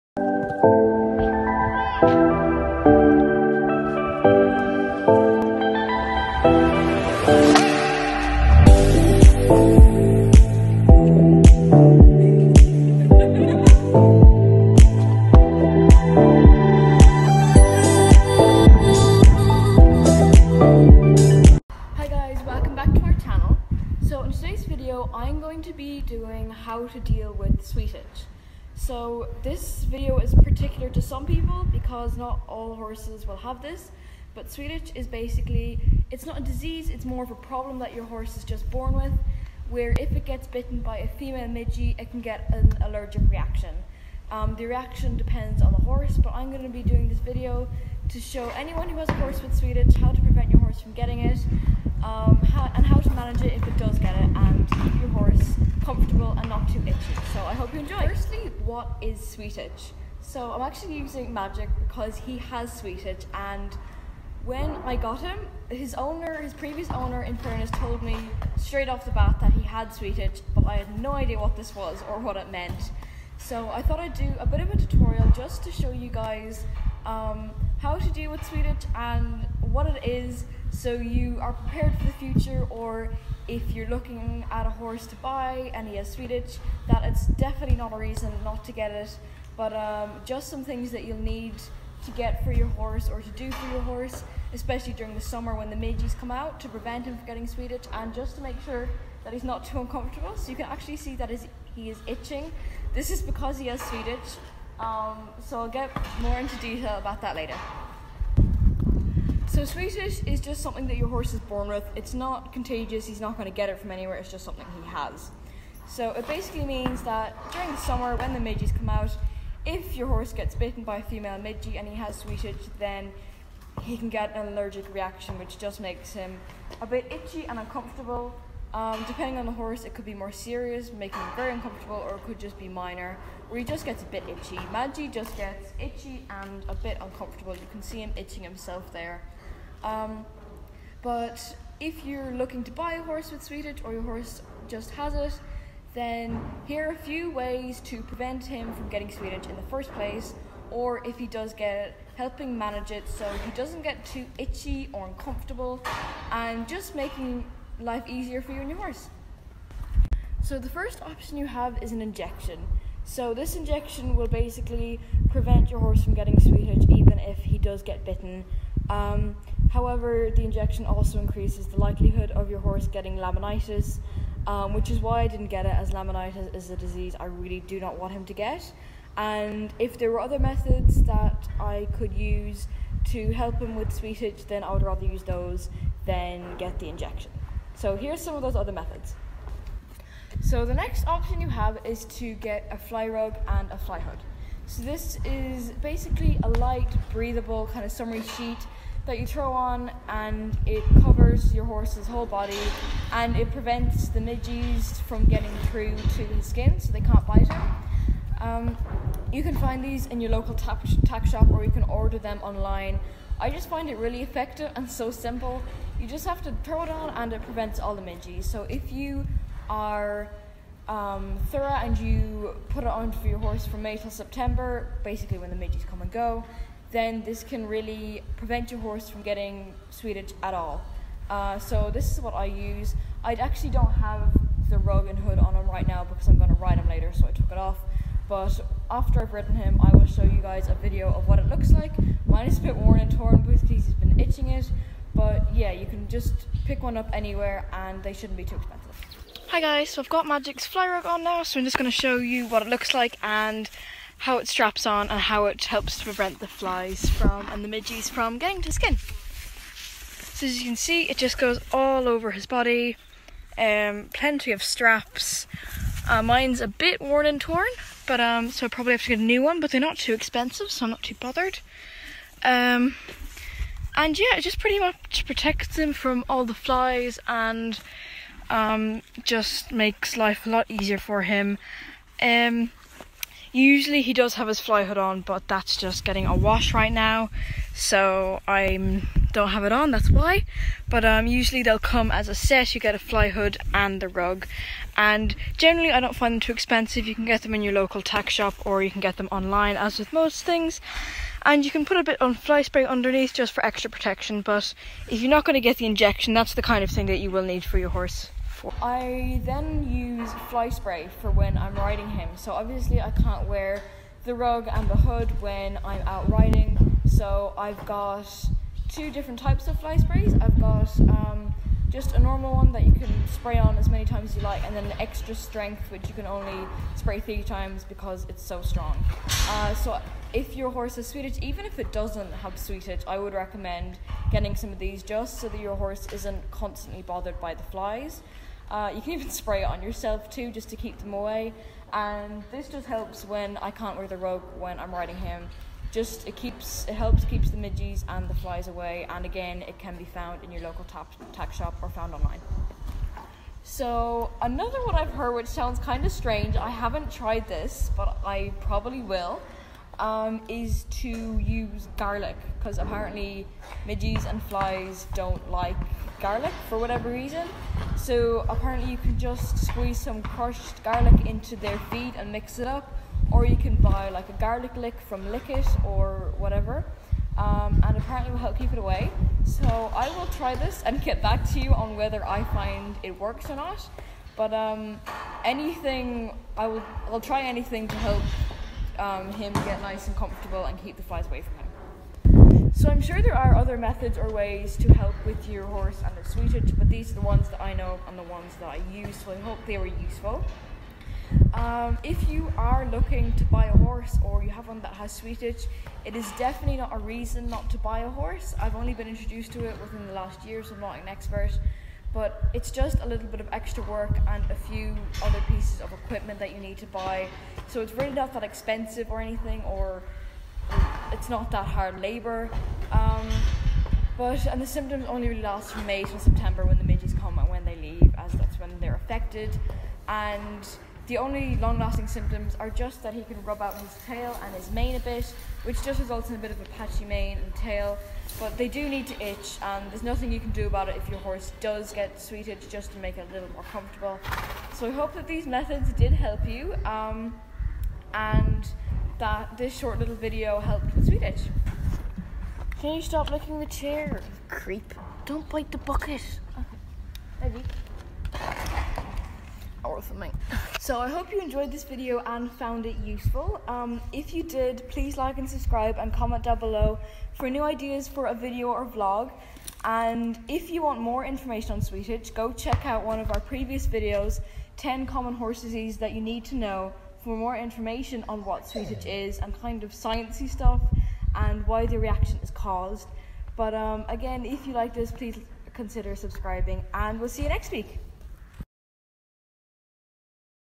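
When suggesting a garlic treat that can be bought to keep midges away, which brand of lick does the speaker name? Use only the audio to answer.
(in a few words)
Likit.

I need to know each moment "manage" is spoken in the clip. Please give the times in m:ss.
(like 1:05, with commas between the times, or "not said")
0:53, 2:32.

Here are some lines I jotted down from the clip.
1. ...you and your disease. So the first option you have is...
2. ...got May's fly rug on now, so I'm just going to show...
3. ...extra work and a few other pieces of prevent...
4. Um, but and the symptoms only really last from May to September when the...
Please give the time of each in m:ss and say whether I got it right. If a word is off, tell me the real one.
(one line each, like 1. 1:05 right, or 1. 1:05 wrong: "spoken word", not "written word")
1. 2:38 wrong: "horse", not "disease"
2. 4:10 wrong: "Magic", not "May"
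3. 6:53 wrong: "equipment", not "prevent"
4. 7:02 right.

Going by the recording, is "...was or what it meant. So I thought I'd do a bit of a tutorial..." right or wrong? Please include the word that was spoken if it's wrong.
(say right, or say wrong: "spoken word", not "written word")
right.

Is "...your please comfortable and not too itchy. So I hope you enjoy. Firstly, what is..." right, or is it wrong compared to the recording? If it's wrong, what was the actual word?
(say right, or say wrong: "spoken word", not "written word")
wrong: "horse", not "please".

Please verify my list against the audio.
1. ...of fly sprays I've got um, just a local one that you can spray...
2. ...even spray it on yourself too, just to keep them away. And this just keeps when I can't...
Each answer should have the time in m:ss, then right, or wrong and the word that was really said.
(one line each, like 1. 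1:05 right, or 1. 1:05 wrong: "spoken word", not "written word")
1. 5:19 wrong: "normal", not "local"
2. 5:39 wrong: "helps", not "keeps".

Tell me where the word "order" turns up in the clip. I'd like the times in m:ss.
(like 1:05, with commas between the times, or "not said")
3:31.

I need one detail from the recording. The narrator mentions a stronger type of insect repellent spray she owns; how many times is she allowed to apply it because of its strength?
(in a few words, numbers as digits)
3.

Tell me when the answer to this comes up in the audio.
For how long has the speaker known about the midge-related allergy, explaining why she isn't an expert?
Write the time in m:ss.
6:50.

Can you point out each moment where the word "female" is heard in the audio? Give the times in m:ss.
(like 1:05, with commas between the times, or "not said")
0:41, 2:01.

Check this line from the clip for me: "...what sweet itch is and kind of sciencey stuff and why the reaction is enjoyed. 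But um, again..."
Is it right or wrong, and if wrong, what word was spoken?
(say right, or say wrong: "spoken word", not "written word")
wrong: "caused", not "enjoyed".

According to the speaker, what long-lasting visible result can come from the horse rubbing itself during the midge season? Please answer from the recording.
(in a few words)
patchy mane and tail.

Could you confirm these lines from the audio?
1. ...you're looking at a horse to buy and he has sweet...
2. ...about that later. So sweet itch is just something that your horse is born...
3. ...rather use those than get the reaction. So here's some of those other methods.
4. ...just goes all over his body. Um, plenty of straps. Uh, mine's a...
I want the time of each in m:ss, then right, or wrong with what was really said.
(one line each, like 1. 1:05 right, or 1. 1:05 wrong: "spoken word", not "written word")
1. 1:23 right
2. 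1:46 right
3. 3:04 wrong: "injection", not "reaction"
4. 4:21 right.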